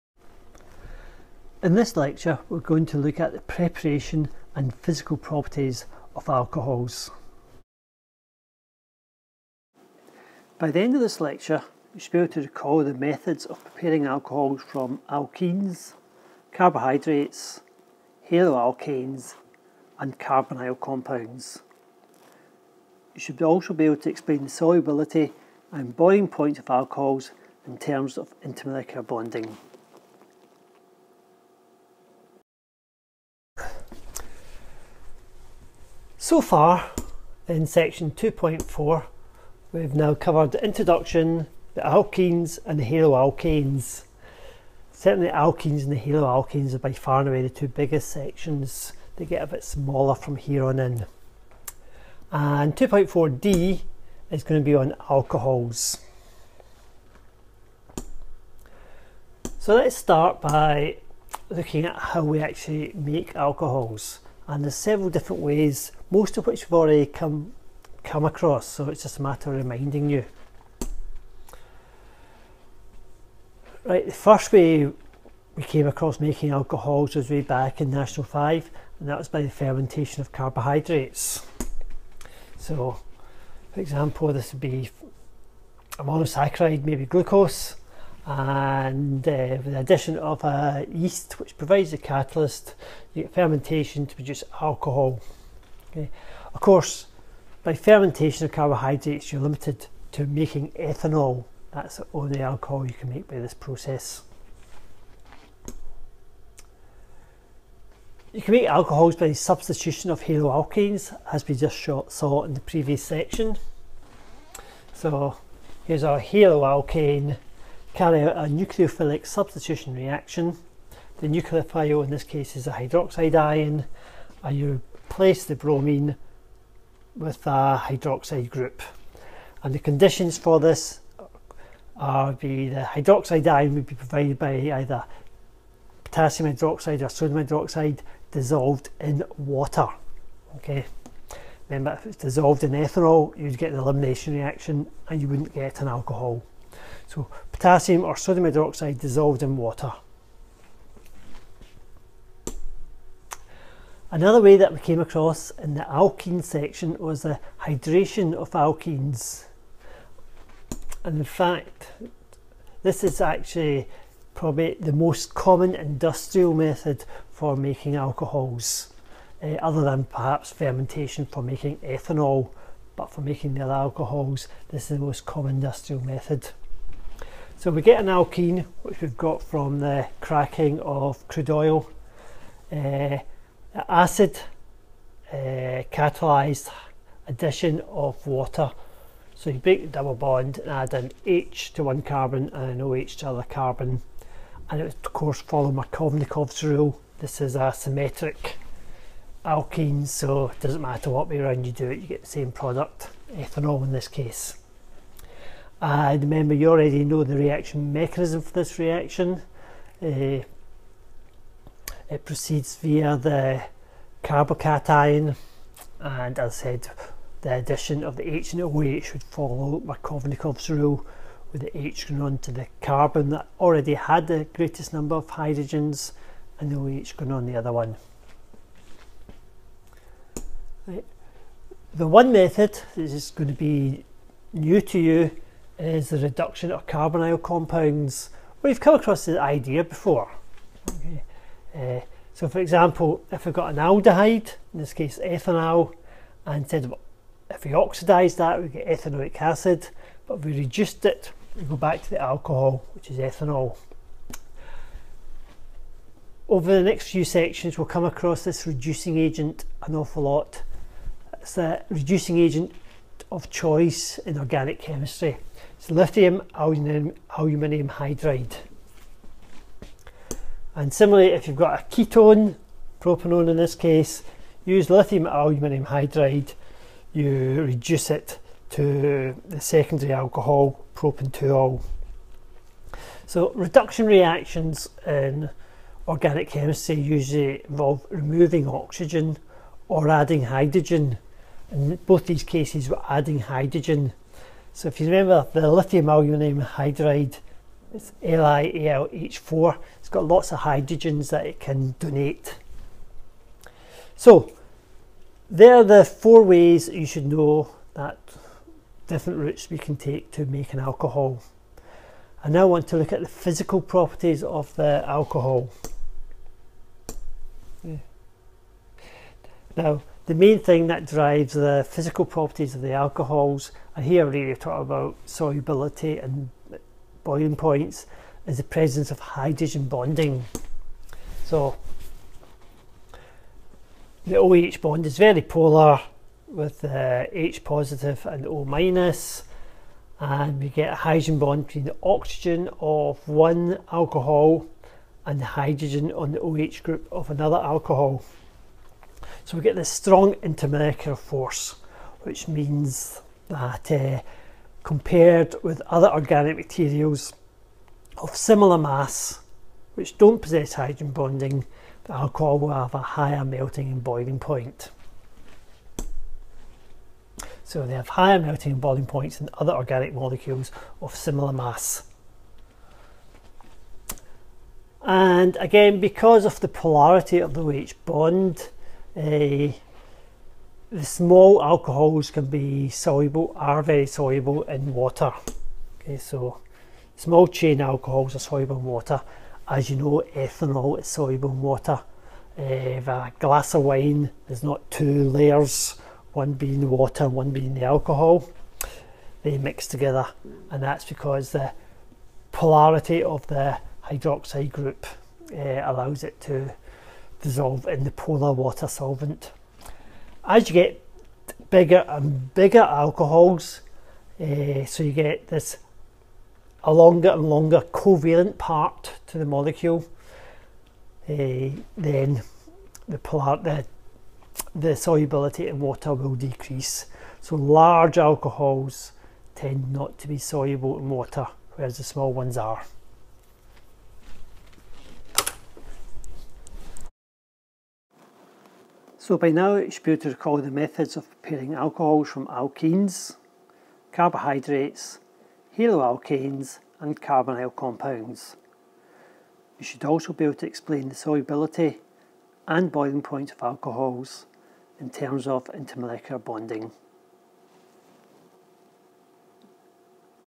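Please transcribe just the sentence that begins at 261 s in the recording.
It's a reducing agent of choice in organic chemistry.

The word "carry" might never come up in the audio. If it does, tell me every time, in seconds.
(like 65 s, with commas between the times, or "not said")
117 s.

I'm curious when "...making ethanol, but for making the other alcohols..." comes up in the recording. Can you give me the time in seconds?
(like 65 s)
171 s.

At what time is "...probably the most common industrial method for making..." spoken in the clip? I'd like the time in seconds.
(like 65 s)
164 s.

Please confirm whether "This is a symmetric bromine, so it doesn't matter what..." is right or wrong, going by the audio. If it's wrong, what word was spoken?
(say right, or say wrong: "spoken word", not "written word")
wrong: "alkene", not "bromine".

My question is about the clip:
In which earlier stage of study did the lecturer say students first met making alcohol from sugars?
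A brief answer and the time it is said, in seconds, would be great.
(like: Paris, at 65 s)
National 5, at 77 s.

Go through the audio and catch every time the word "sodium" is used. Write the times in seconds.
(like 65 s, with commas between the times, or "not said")
137 s, 148 s.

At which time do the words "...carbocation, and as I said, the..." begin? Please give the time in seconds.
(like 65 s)
214 s.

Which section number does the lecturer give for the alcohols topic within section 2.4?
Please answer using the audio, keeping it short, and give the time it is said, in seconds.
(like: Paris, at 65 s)
2.4d, at 52 s.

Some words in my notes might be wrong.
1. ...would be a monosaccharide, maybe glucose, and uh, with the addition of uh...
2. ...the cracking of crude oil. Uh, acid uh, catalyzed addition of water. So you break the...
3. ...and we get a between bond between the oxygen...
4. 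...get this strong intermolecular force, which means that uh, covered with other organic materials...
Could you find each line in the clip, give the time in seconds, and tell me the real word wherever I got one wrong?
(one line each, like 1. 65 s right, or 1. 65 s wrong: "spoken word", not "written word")
1. 84 s right
2. 179 s right
3. 340 s wrong: "hydrogen", not "between"
4. 349 s wrong: "compared", not "covered".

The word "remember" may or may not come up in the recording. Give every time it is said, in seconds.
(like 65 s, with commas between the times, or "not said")
141 s, 206 s, 295 s.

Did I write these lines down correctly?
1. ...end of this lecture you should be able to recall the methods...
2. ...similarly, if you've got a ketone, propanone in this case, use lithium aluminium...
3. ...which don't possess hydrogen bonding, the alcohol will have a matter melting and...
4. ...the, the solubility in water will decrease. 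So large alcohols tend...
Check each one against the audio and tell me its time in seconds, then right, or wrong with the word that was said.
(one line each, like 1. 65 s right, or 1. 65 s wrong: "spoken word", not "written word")
1. 10 s right
2. 270 s right
3. 359 s wrong: "higher", not "matter"
4. 423 s right.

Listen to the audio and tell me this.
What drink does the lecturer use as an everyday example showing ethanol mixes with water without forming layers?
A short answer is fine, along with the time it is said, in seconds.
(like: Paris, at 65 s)
Wine, at 393 s.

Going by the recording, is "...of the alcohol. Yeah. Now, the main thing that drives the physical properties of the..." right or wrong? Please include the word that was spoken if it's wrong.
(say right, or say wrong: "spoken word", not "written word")
right.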